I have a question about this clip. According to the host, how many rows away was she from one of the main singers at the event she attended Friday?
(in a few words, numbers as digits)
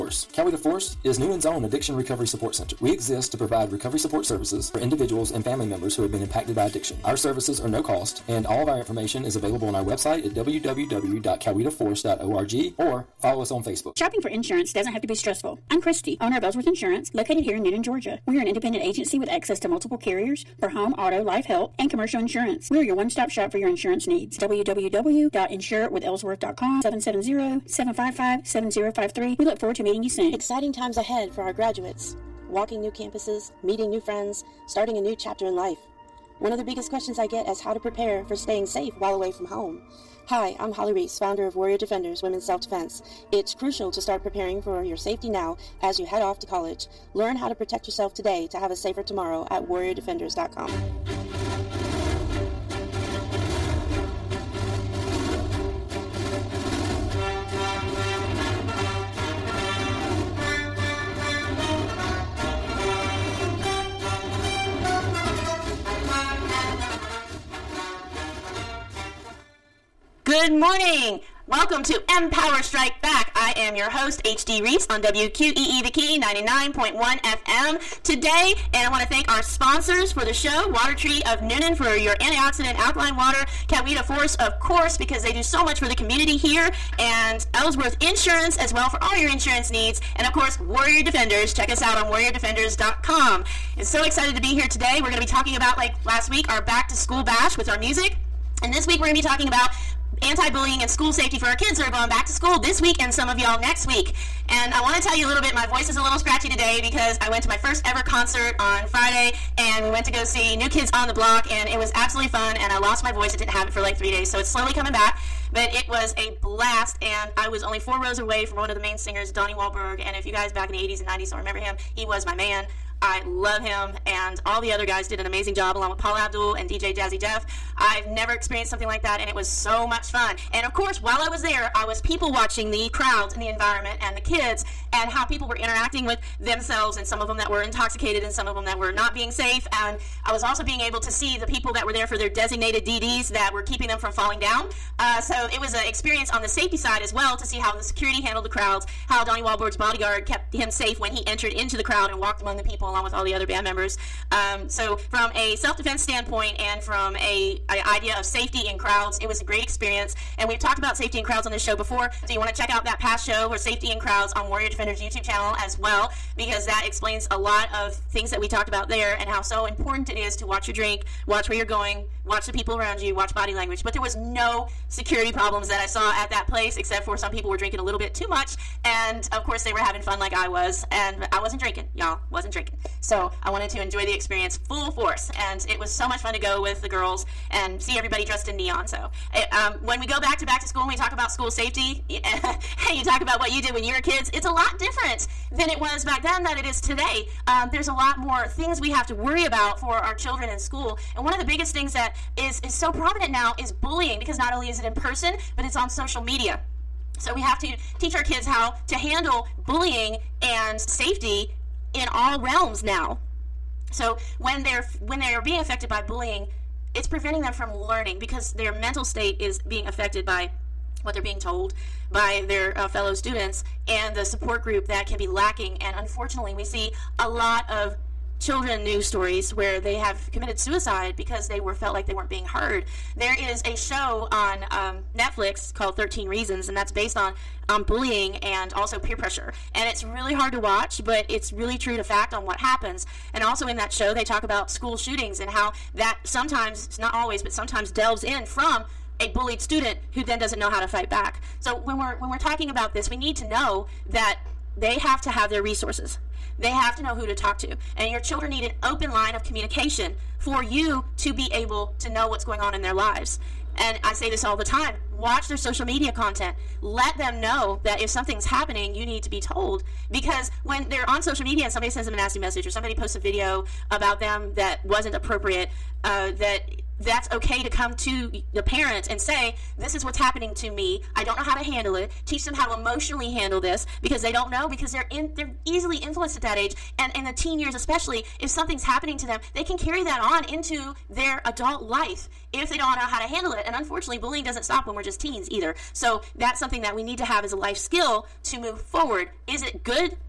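4.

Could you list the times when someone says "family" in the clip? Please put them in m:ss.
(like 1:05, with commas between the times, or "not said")
0:05.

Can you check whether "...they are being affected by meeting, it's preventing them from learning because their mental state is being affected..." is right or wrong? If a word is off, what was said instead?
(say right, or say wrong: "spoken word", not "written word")
wrong: "bullying", not "meeting".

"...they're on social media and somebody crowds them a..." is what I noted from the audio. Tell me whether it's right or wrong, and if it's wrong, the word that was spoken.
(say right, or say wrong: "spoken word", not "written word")
wrong: "sends", not "crowds".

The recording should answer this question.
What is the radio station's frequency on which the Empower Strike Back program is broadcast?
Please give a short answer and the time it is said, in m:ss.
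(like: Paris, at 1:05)
99.1 FM, at 1:16.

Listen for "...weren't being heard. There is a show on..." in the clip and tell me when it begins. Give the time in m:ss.
3:52.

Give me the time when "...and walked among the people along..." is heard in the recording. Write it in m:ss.
2:32.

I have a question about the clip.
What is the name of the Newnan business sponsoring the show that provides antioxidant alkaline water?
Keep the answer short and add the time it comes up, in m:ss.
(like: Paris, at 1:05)
Water Tree, at 1:20.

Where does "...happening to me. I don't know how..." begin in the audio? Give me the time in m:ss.
4:40.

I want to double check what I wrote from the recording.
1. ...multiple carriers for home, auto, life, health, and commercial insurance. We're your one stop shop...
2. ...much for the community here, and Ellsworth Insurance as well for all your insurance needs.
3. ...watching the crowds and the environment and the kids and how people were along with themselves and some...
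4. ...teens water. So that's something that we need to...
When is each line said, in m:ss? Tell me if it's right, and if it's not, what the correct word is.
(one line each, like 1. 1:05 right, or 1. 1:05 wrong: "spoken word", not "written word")
1. 0:19 right
2. 1:25 right
3. 2:12 wrong: "interacting", not "along"
4. 4:55 wrong: "either", not "water".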